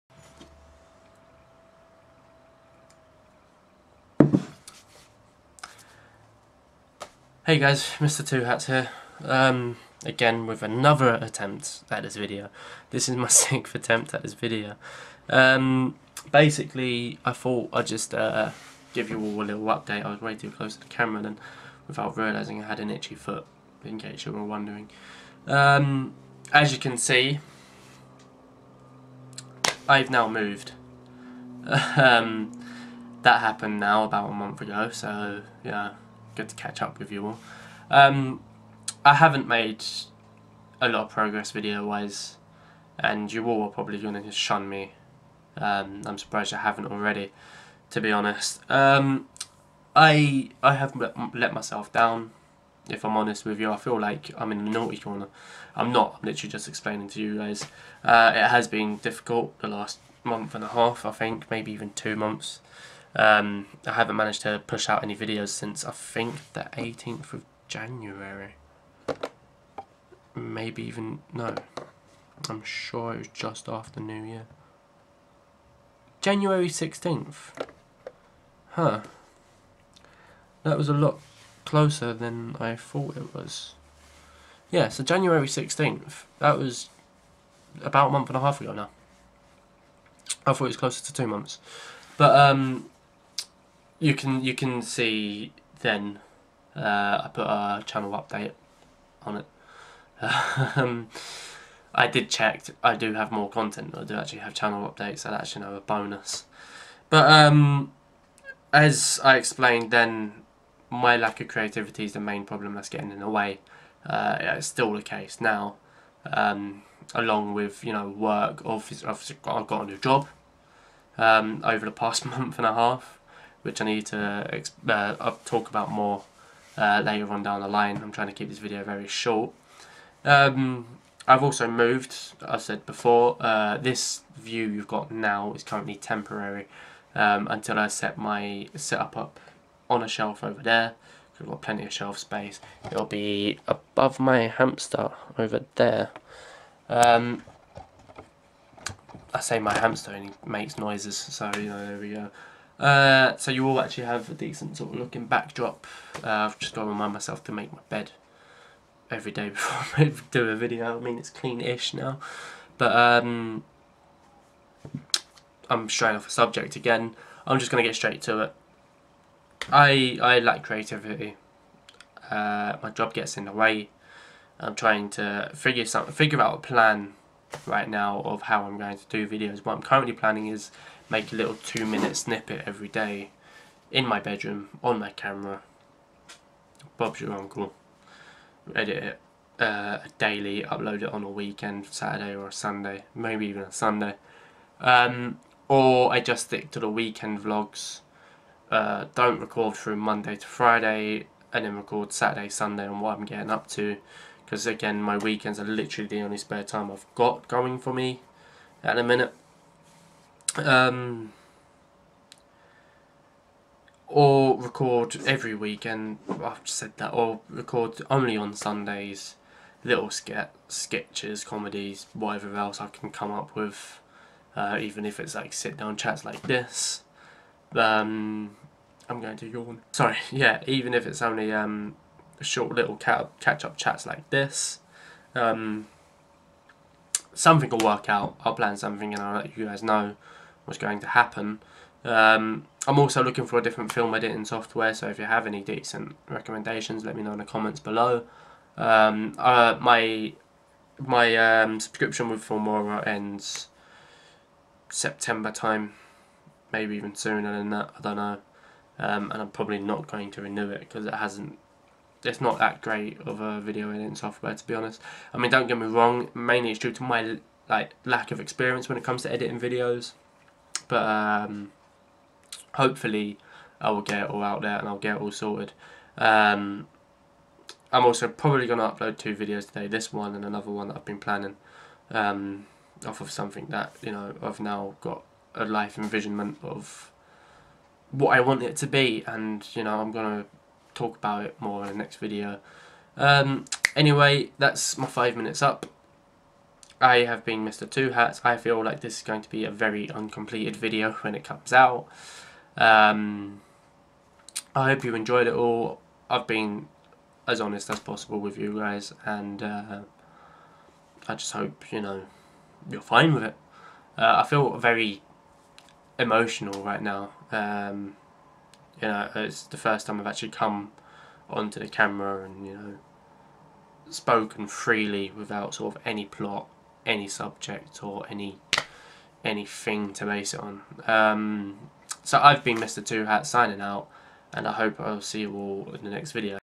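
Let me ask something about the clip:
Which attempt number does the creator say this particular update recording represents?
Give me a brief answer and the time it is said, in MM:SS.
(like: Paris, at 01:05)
6th, at 00:13.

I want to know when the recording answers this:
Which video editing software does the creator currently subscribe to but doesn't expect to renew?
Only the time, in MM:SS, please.
04:12.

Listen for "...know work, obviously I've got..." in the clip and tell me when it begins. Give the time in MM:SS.
01:57.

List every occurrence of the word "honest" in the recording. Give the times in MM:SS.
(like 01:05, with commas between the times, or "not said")
00:48, 00:53, 04:24, 05:07.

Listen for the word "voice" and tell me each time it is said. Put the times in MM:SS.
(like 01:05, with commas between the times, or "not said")
not said.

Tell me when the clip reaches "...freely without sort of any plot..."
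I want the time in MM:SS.
05:24.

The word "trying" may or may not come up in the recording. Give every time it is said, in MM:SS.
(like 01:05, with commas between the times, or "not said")
02:08, 02:54.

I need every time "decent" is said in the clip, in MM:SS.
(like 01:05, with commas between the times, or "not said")
02:34, 04:05.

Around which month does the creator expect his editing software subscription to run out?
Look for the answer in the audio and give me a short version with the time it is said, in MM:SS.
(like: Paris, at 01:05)
September, at 04:14.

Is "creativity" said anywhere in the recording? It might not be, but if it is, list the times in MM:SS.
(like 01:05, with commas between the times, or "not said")
01:51, 02:50.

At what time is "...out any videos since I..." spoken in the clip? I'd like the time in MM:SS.
01:04.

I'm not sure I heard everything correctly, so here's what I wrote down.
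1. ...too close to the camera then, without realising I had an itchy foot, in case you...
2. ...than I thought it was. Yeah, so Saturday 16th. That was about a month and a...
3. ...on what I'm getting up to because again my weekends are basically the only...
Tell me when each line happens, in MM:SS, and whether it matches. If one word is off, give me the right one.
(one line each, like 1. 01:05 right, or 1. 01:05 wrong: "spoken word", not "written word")
1. 00:20 right
2. 01:22 wrong: "January", not "Saturday"
3. 03:22 wrong: "literally", not "basically".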